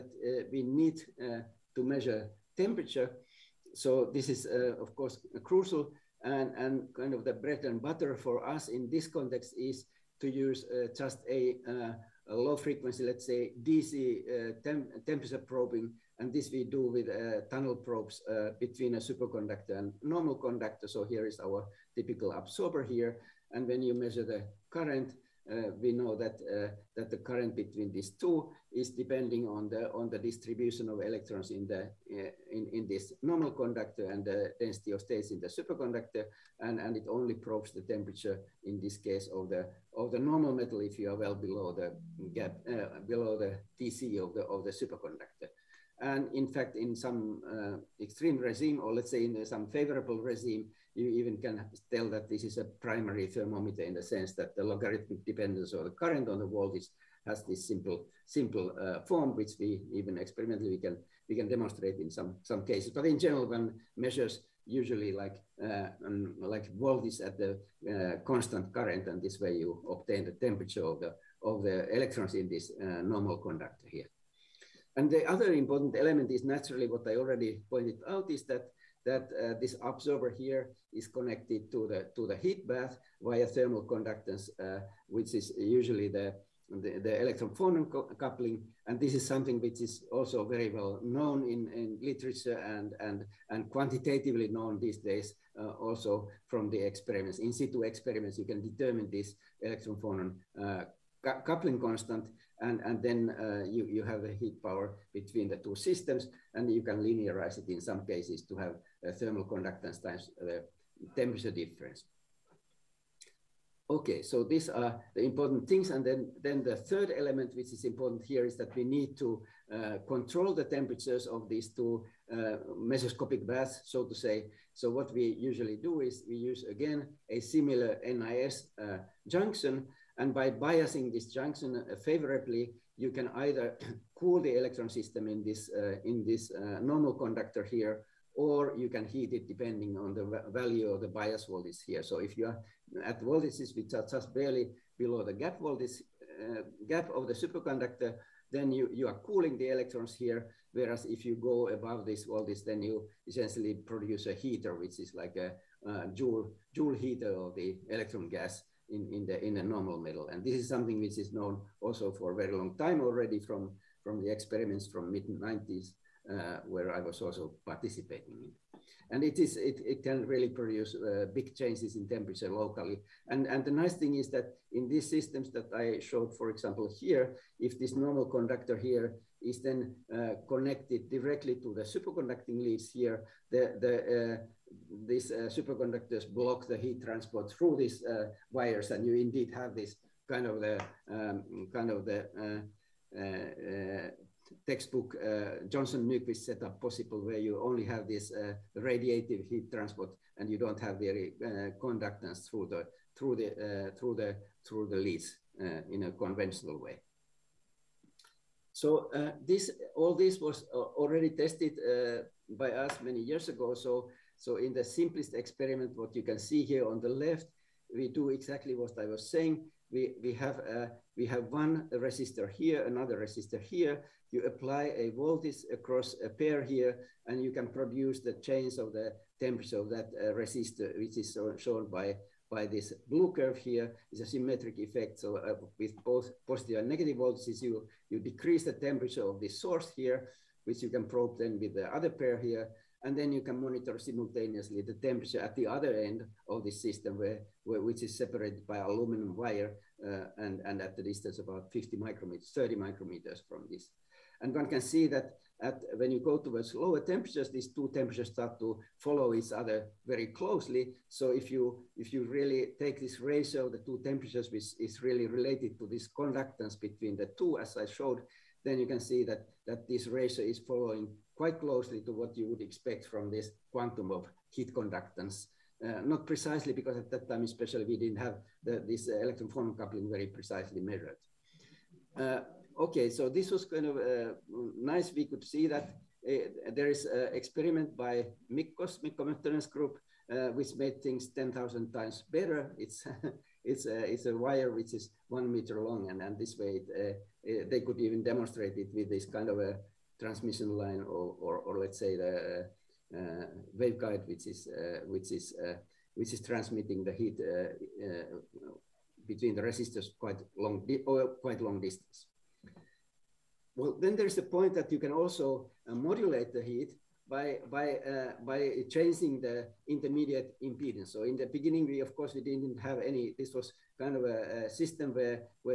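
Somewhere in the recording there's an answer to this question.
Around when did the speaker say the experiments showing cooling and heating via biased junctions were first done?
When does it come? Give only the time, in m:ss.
2:45.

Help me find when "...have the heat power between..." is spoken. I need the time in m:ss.
1:44.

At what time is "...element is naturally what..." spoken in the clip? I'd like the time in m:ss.
1:15.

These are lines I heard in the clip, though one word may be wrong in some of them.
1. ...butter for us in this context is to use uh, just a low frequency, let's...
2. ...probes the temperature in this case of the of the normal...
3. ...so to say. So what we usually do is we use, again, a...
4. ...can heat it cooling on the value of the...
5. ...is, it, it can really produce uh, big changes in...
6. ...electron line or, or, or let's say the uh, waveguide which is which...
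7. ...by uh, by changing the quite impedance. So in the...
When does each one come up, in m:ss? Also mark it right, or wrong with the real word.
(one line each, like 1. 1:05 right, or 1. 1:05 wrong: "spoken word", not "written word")
1. 0:07 right
2. 0:37 right
3. 2:03 right
4. 2:18 wrong: "depending", not "cooling"
5. 2:49 right
6. 5:00 wrong: "transmission", not "electron"
7. 5:17 wrong: "intermediate", not "quite".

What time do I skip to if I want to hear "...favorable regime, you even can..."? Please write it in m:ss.
0:49.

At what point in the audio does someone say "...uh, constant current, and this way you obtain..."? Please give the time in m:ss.
1:07.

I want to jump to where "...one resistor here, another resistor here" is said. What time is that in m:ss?
3:41.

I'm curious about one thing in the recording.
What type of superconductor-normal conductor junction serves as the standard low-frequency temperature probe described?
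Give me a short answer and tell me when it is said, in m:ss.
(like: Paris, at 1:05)
Tunnel probes, at 0:17.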